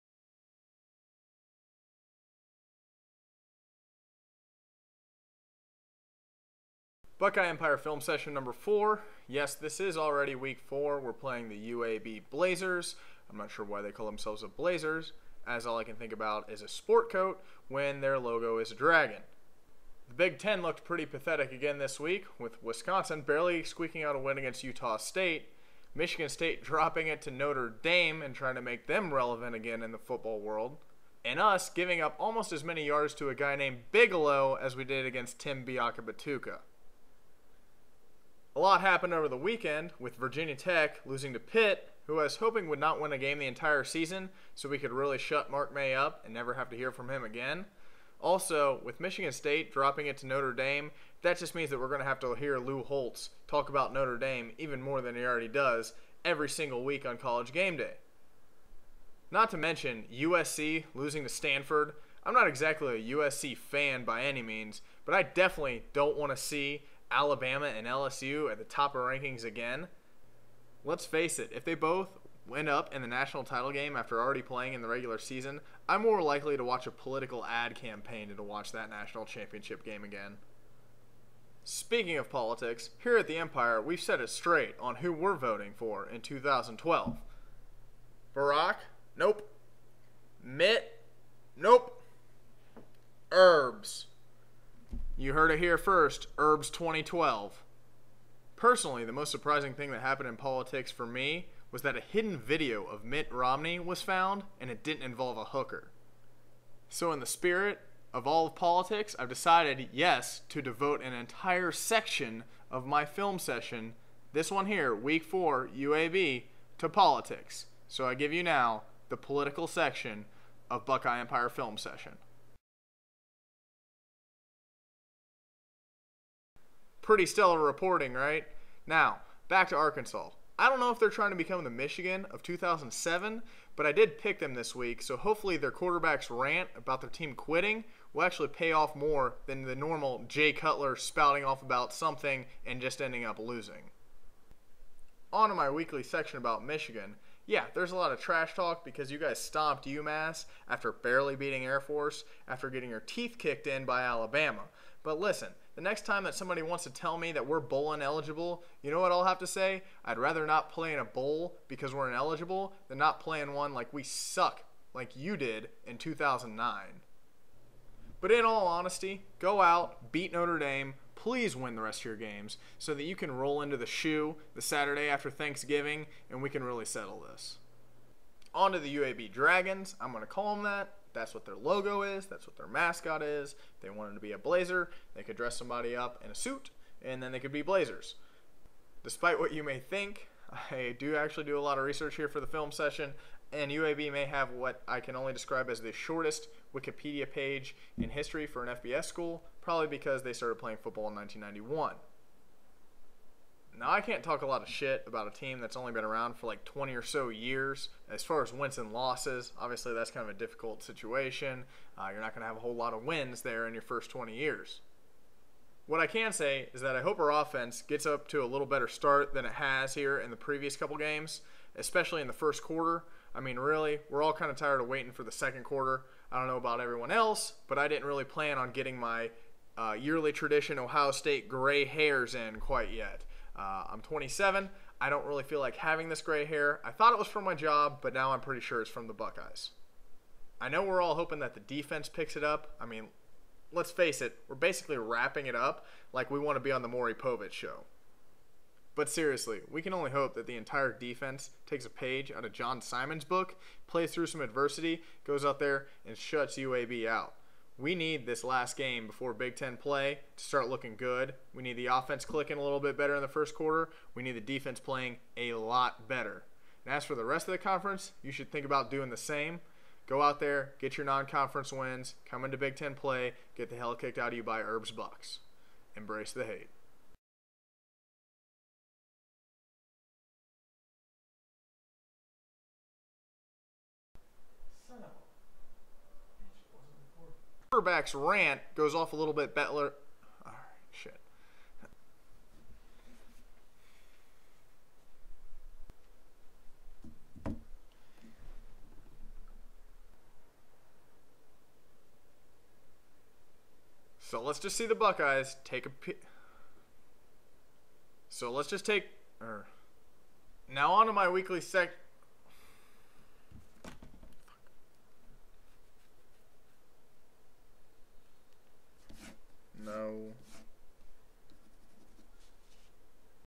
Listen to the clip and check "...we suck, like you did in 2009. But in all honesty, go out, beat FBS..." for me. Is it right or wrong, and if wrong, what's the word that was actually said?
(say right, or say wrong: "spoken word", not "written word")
wrong: "Notre", not "FBS".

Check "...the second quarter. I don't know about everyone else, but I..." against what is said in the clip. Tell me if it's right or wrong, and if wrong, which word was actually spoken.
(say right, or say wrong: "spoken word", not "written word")
right.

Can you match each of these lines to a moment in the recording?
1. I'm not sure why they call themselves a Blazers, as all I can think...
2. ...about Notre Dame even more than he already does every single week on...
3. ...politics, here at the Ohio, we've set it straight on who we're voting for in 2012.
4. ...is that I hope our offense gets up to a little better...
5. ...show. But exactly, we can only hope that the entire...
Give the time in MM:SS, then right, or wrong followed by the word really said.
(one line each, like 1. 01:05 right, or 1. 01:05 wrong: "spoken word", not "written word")
1. 00:13 right
2. 00:53 right
3. 01:22 wrong: "Empire", not "Ohio"
4. 03:36 right
5. 04:07 wrong: "seriously", not "exactly".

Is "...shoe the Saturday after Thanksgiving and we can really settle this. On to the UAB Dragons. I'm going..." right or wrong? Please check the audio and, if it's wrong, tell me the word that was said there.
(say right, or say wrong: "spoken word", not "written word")
right.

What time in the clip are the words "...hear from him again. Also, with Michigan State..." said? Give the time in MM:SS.
00:46.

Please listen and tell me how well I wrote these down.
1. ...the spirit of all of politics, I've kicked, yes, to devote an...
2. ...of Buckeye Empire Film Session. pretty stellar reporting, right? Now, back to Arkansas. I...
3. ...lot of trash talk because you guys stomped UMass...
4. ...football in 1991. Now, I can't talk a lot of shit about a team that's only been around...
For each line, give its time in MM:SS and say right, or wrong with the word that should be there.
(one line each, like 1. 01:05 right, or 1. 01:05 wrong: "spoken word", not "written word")
1. 01:47 wrong: "decided", not "kicked"
2. 02:00 right
3. 02:27 right
4. 03:20 right.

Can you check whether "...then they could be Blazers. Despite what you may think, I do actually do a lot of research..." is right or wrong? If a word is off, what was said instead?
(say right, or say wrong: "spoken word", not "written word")
right.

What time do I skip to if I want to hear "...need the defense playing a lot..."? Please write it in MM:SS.
04:24.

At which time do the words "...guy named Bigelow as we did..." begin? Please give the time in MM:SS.
00:33.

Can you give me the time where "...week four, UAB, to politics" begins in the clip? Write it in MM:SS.
01:54.